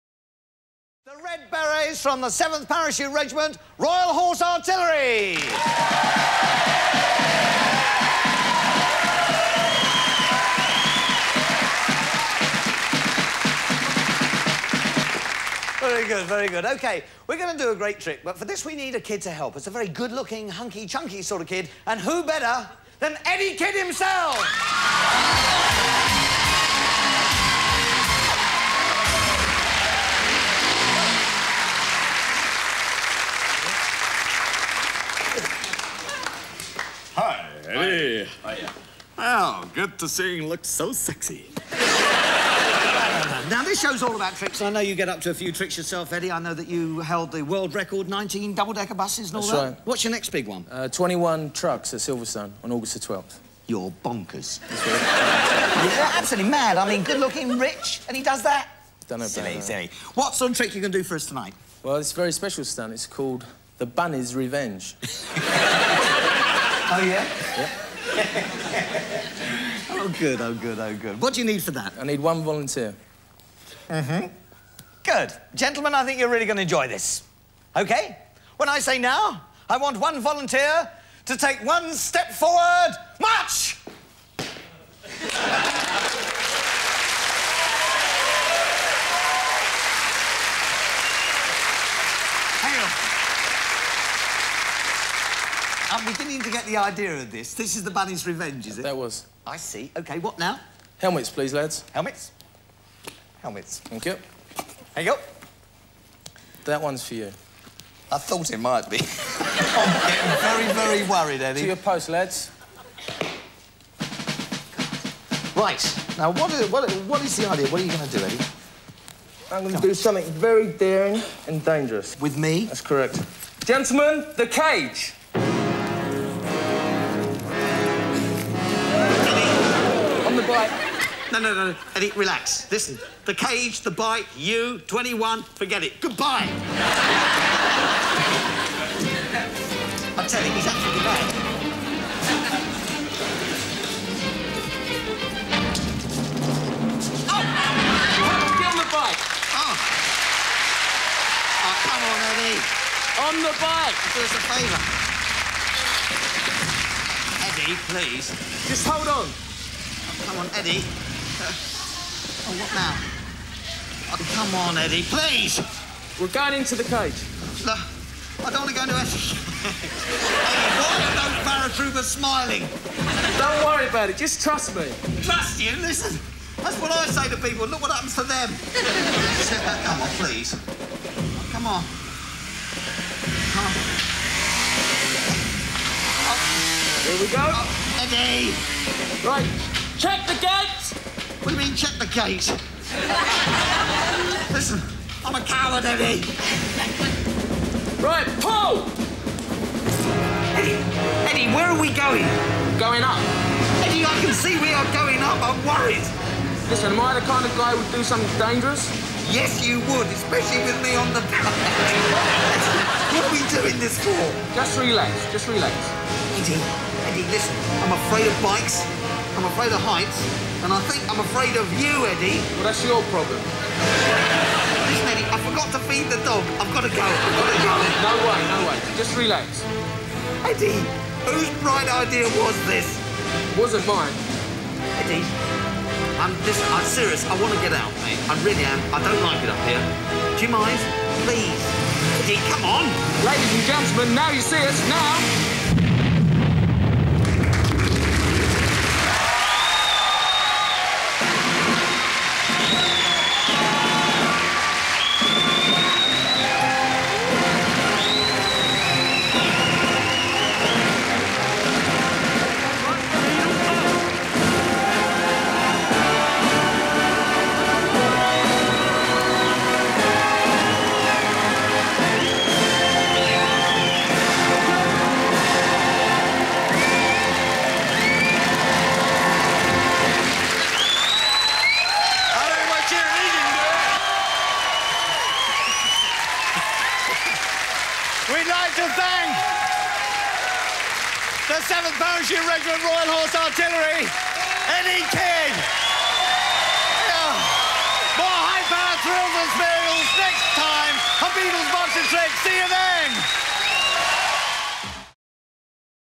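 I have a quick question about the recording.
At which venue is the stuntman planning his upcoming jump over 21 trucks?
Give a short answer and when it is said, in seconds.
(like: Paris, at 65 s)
Silverstone, at 51 s.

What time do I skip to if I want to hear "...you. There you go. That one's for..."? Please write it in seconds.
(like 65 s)
104 s.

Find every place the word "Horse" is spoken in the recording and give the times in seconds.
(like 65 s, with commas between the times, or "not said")
4 s, 293 s.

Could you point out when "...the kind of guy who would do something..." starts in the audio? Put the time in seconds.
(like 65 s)
207 s.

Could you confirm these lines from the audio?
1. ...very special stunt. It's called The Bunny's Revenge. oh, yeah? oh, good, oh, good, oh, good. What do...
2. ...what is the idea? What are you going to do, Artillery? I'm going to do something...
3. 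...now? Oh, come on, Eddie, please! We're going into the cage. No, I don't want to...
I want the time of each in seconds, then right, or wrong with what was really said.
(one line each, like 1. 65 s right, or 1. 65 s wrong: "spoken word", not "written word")
1. 62 s right
2. 117 s wrong: "Eddie", not "Artillery"
3. 162 s right.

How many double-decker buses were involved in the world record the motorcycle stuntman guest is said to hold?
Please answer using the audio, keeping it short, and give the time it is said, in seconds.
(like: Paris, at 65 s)
19, at 48 s.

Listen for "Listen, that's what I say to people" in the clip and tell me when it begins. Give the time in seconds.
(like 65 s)
175 s.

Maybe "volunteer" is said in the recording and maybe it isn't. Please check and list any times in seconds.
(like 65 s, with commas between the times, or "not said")
72 s, 80 s.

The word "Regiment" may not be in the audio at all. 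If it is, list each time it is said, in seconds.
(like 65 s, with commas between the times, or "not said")
3 s, 292 s.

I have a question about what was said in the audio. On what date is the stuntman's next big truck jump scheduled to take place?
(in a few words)
August 12.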